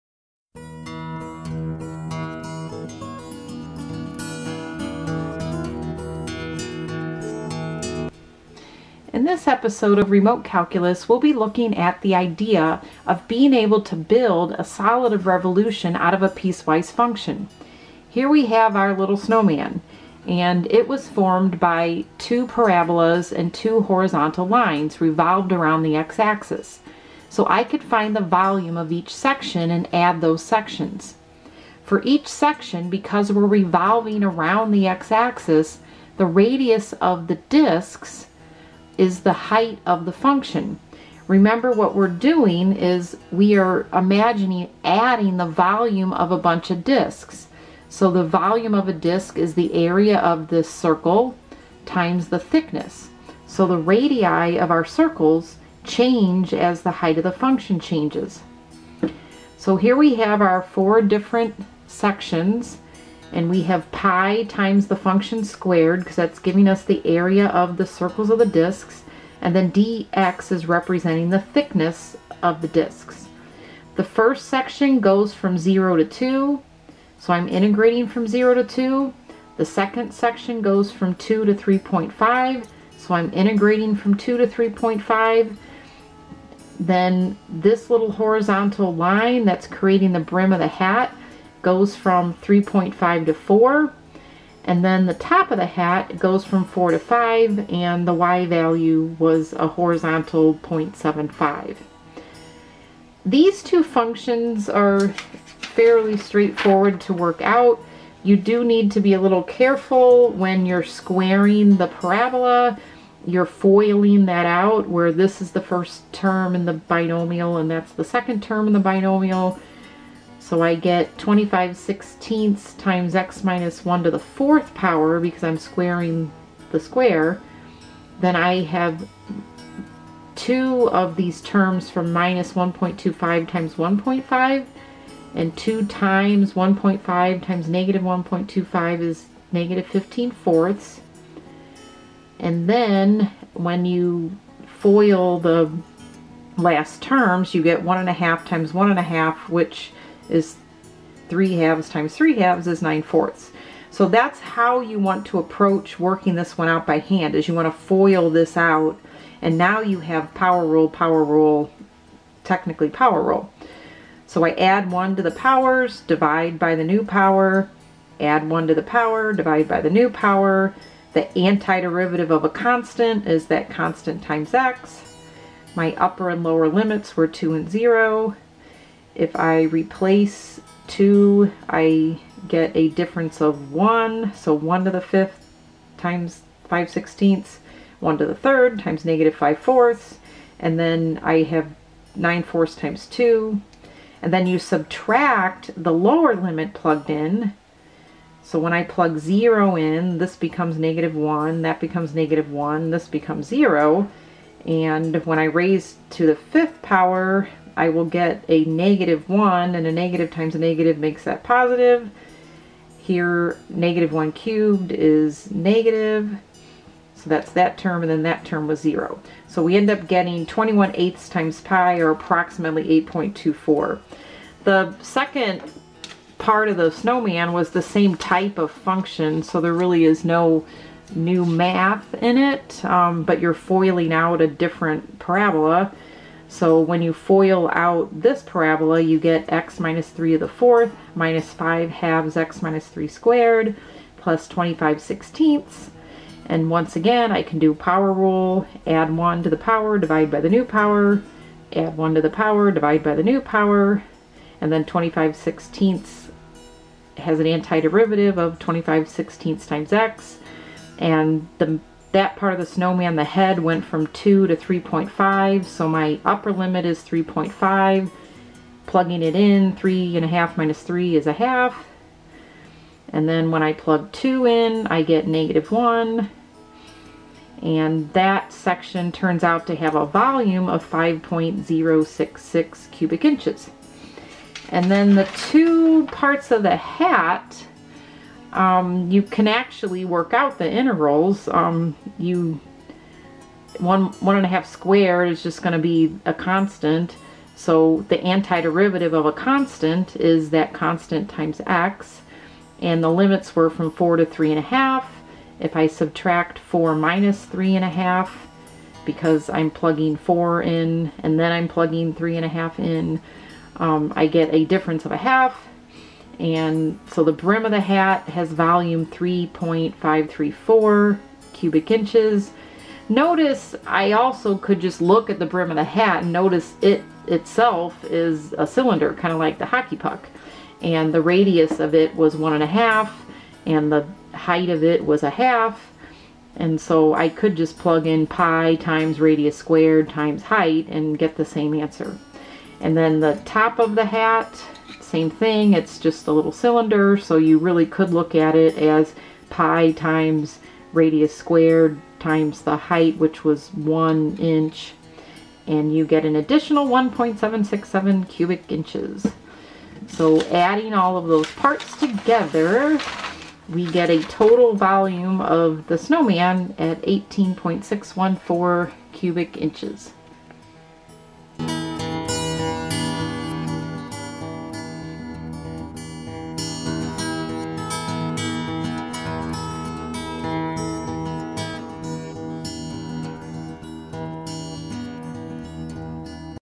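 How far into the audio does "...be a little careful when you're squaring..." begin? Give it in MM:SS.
01:48.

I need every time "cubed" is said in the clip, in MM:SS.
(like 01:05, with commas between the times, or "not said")
03:34.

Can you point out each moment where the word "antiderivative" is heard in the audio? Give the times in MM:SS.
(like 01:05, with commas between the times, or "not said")
02:51, 04:17, 04:58.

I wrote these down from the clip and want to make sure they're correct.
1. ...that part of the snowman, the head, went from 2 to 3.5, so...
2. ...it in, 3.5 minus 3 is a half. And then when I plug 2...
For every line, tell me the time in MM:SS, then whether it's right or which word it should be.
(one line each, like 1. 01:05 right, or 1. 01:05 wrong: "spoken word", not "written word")
1. 04:22 right
2. 04:29 right.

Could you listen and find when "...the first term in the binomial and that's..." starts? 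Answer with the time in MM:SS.
01:55.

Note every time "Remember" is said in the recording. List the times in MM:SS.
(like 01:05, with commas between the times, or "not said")
00:41.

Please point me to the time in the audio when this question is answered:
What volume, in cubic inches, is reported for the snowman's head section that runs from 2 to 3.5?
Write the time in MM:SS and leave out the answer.
04:40.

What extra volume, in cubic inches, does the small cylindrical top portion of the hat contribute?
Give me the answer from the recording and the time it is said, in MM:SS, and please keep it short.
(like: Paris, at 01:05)
1.767, at 05:56.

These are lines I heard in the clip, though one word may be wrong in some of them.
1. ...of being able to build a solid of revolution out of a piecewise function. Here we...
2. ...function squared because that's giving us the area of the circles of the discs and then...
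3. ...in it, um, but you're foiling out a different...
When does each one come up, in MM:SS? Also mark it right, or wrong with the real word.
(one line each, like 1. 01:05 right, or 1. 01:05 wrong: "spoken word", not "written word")
1. 00:13 right
2. 01:04 right
3. 03:52 right.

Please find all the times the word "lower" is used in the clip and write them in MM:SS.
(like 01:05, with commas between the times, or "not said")
02:56, 03:15.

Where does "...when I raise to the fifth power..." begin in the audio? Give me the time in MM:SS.
03:25.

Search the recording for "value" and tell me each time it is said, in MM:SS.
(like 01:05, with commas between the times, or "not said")
01:38.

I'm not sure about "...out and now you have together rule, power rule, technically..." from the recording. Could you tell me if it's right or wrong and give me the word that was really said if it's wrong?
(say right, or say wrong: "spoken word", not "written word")
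wrong: "power", not "together".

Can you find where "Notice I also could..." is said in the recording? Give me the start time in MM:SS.
05:23.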